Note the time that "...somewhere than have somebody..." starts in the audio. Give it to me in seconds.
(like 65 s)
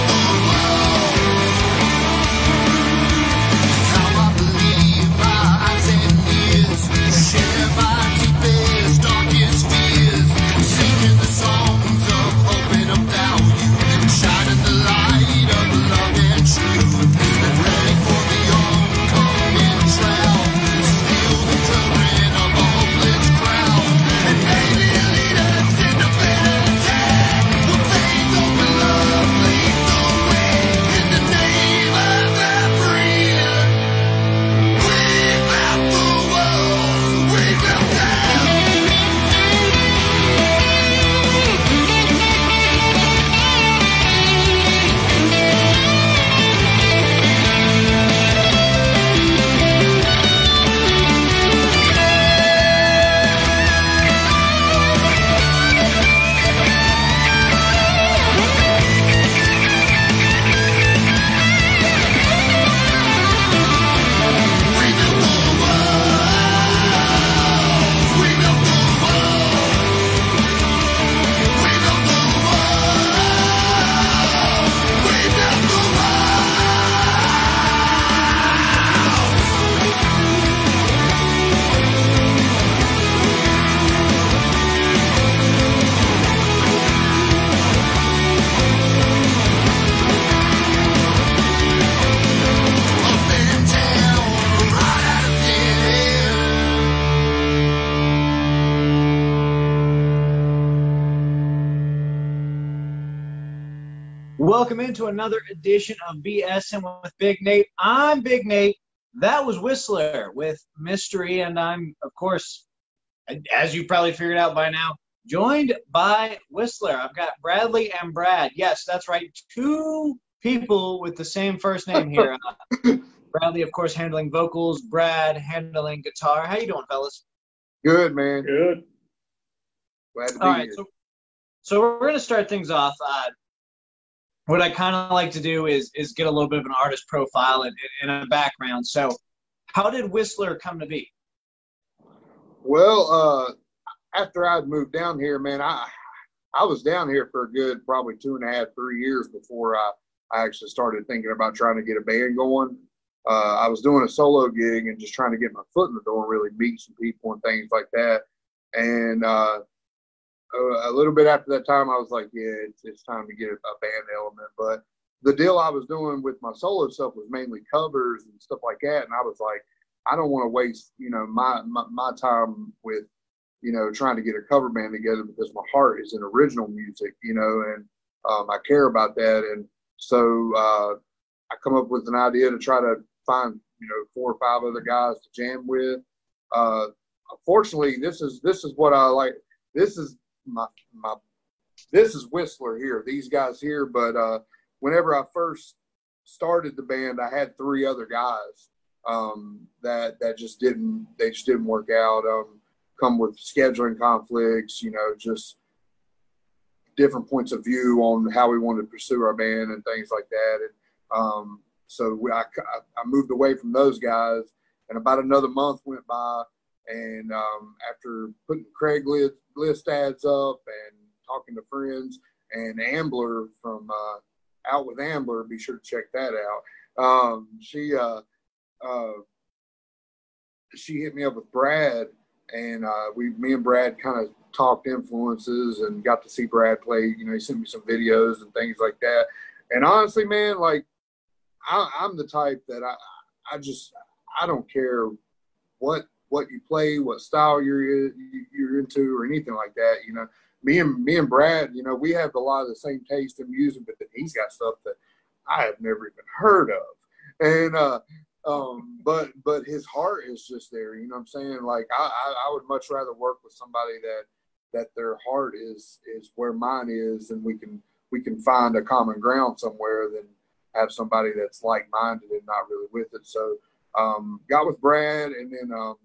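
269 s.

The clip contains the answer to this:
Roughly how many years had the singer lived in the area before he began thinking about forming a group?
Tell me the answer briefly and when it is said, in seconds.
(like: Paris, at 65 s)
2.5 to 3 years, at 148 s.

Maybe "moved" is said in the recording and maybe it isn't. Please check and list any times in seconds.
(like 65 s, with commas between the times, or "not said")
144 s, 213 s.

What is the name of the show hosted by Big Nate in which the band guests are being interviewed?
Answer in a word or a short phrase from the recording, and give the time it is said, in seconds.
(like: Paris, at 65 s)
BS'n with Big Nate, at 106 s.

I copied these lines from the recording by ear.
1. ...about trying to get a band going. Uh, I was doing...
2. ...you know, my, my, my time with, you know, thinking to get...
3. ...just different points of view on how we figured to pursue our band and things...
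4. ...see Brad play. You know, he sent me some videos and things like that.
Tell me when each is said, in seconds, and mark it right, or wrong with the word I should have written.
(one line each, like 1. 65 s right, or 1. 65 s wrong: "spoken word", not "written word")
1. 151 s right
2. 170 s wrong: "trying", not "thinking"
3. 205 s wrong: "wanted", not "figured"
4. 236 s right.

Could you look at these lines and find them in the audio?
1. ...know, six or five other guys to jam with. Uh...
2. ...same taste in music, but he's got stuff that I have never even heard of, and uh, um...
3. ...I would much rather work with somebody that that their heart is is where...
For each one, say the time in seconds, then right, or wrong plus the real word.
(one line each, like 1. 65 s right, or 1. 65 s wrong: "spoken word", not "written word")
1. 183 s wrong: "four", not "six"
2. 252 s right
3. 262 s right.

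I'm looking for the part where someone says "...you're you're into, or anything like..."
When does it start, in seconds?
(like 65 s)
247 s.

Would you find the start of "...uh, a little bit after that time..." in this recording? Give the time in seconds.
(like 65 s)
160 s.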